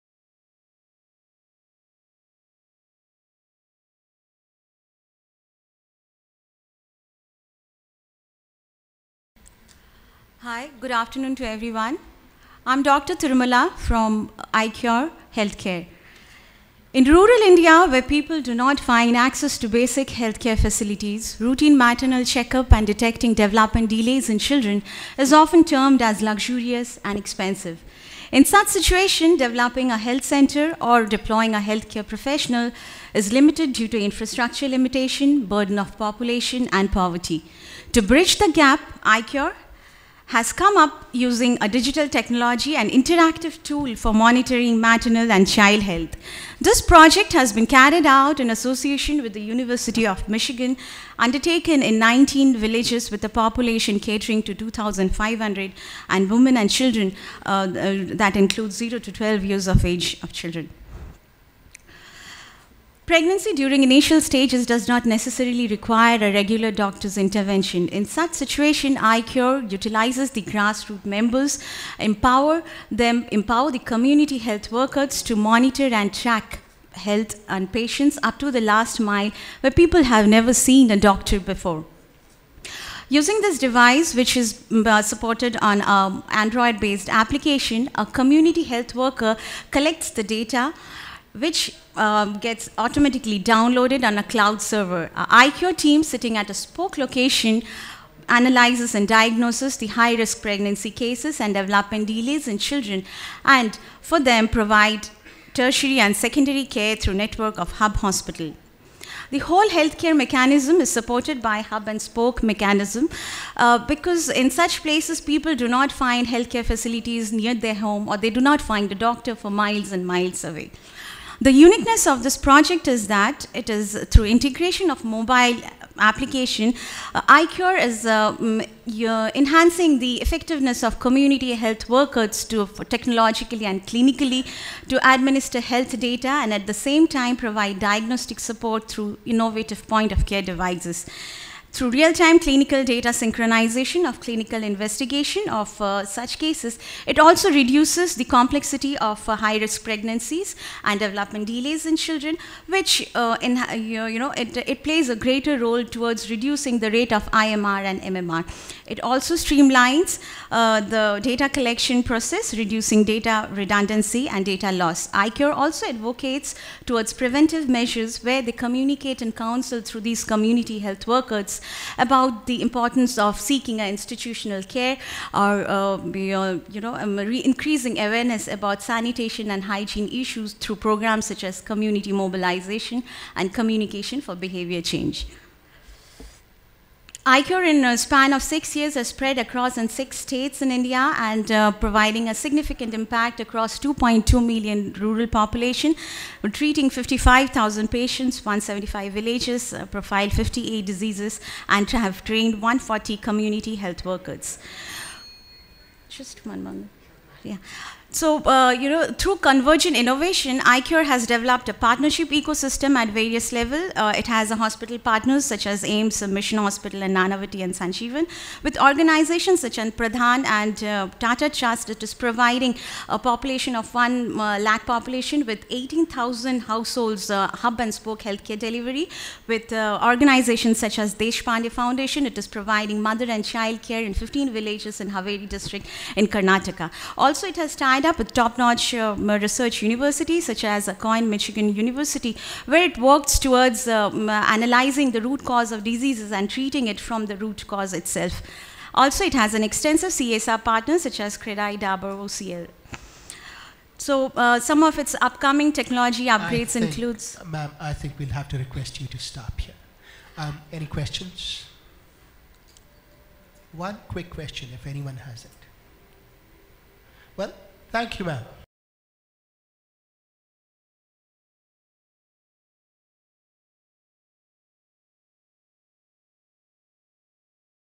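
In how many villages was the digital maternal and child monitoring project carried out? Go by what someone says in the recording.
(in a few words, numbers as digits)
19.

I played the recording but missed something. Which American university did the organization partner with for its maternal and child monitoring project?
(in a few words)
University of Michigan.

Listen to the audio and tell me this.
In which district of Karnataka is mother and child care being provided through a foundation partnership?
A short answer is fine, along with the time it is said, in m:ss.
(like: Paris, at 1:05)
Haveri, at 3:55.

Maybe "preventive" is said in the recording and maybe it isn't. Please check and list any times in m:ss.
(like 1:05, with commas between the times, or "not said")
2:47.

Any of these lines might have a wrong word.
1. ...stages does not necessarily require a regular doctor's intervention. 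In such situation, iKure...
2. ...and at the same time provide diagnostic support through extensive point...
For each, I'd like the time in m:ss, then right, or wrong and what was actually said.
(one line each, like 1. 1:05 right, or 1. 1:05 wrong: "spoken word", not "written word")
1. 1:04 right
2. 2:16 wrong: "innovative", not "extensive".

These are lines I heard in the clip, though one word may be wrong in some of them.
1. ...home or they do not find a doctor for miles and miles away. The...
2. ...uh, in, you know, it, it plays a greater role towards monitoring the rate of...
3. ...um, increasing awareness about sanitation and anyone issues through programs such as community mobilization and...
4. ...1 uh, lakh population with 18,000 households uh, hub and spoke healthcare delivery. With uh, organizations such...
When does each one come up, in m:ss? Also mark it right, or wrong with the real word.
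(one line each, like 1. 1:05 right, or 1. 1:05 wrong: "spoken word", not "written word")
1. 1:57 right
2. 2:33 wrong: "reducing", not "monitoring"
3. 2:56 wrong: "hygiene", not "anyone"
4. 3:43 right.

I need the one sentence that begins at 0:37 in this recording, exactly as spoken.
To bridge the gap, iKure has come up using a digital technology and interactive tool for monitoring maternal and child health.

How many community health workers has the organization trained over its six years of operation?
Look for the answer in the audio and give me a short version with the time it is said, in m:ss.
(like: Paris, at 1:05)
140, at 3:22.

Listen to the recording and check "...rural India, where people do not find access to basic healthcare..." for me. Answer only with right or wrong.
right.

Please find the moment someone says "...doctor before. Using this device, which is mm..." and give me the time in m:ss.
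1:20.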